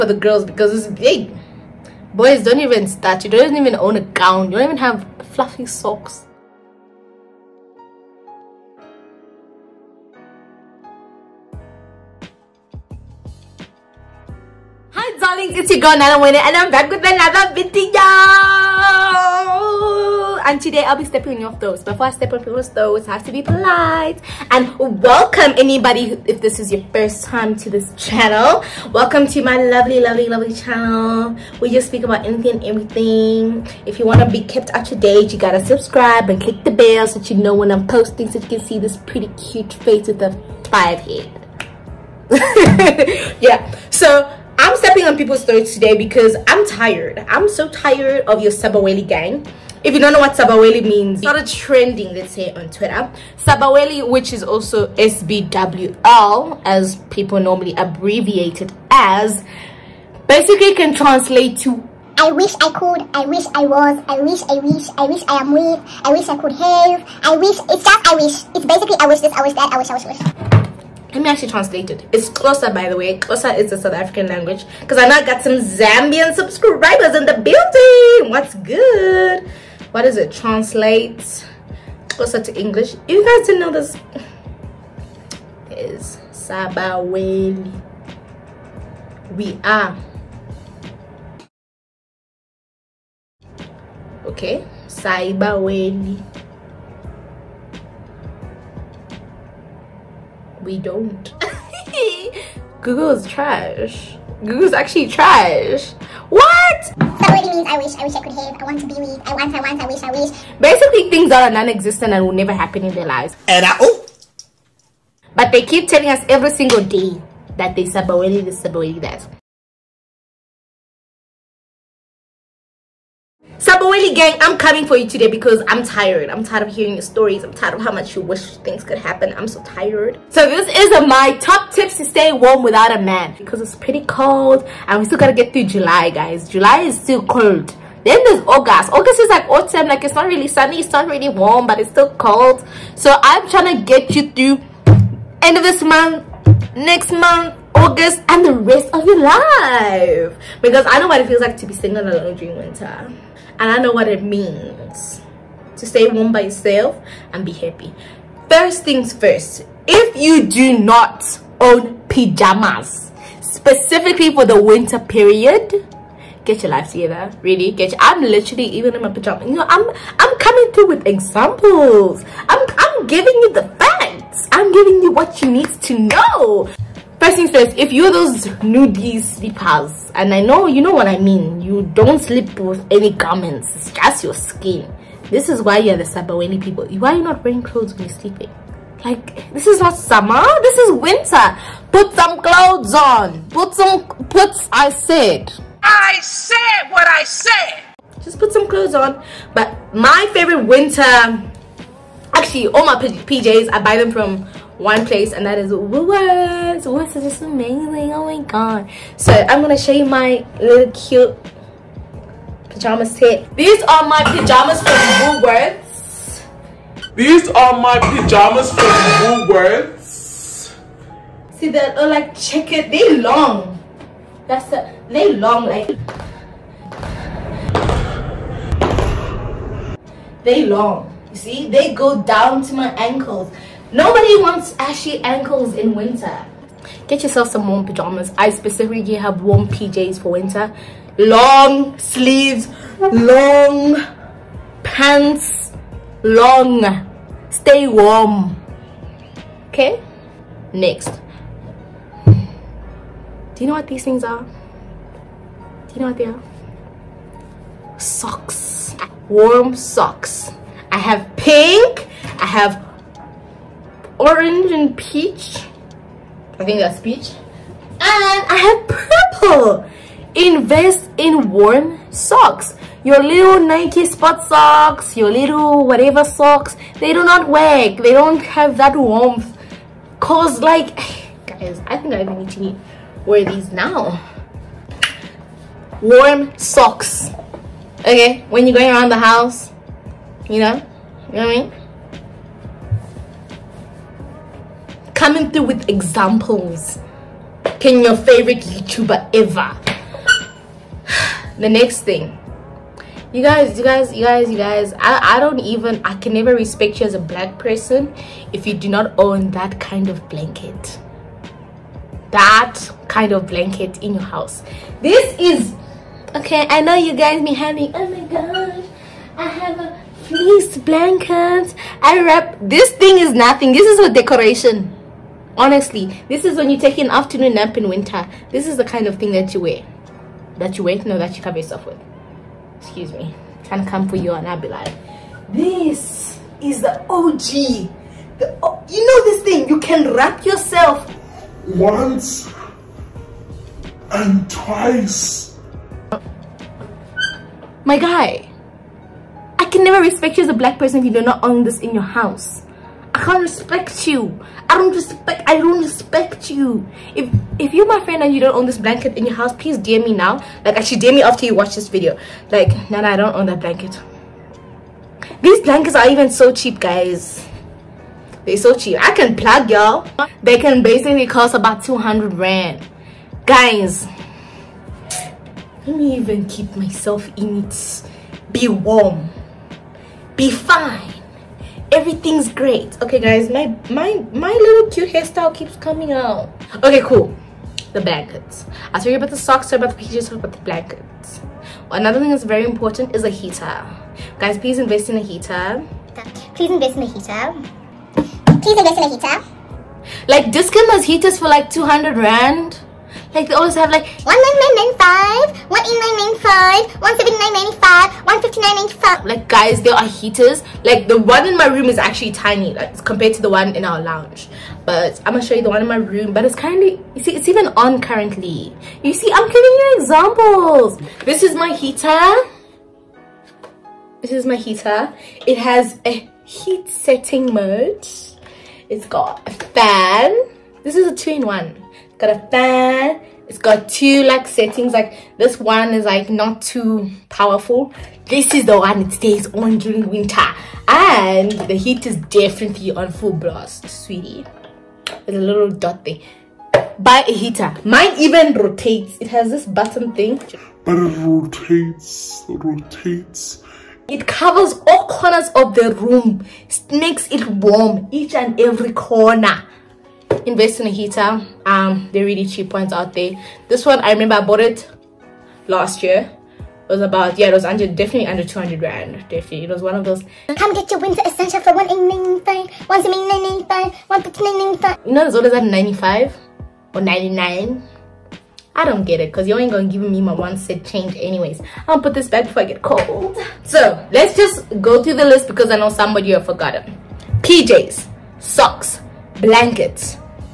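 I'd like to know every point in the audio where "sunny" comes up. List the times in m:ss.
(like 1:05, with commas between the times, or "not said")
2:20.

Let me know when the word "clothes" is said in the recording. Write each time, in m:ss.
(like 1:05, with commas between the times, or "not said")
3:07, 3:12, 3:18.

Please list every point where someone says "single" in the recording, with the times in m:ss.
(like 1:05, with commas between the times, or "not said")
1:56, 2:31.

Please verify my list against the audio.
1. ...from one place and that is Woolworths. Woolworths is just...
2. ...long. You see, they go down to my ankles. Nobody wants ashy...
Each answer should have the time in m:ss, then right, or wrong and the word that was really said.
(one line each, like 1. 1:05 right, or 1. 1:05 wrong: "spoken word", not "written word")
1. 3:24 right
2. 3:50 right.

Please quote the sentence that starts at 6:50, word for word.
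Like the one in my room is actually tiny, like compared to the one in our lounge.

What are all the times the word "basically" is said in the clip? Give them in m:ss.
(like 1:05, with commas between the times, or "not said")
1:00, 1:08, 1:50, 6:10.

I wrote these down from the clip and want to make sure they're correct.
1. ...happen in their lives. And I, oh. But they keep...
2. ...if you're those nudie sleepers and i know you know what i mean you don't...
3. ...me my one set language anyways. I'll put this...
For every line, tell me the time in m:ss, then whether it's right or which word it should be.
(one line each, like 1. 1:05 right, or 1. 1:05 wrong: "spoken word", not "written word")
1. 1:52 right
2. 2:57 right
3. 8:00 wrong: "change", not "language".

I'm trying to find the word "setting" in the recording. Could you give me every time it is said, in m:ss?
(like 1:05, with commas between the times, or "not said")
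7:06, 7:14.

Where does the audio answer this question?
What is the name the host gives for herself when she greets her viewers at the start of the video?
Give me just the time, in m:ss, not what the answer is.
0:15.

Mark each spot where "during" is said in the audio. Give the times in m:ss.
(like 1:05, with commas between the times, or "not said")
2:32, 7:19.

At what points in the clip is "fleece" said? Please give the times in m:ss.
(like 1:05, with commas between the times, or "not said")
5:20.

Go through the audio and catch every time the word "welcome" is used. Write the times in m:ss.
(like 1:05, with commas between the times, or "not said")
0:24, 0:28.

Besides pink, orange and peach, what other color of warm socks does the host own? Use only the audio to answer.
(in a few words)
Purple.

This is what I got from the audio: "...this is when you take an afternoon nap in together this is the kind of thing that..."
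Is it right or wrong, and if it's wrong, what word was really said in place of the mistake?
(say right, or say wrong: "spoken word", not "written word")
wrong: "winter", not "together".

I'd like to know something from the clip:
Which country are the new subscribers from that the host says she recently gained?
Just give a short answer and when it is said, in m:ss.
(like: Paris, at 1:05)
Zambian, at 1:15.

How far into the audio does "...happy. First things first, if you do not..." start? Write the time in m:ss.
2:37.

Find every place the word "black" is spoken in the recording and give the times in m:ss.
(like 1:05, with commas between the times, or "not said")
5:07, 5:50.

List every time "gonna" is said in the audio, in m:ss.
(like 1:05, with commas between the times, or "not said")
3:29, 6:55, 7:59.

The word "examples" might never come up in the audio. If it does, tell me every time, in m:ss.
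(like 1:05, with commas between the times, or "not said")
2:51, 4:55, 6:59.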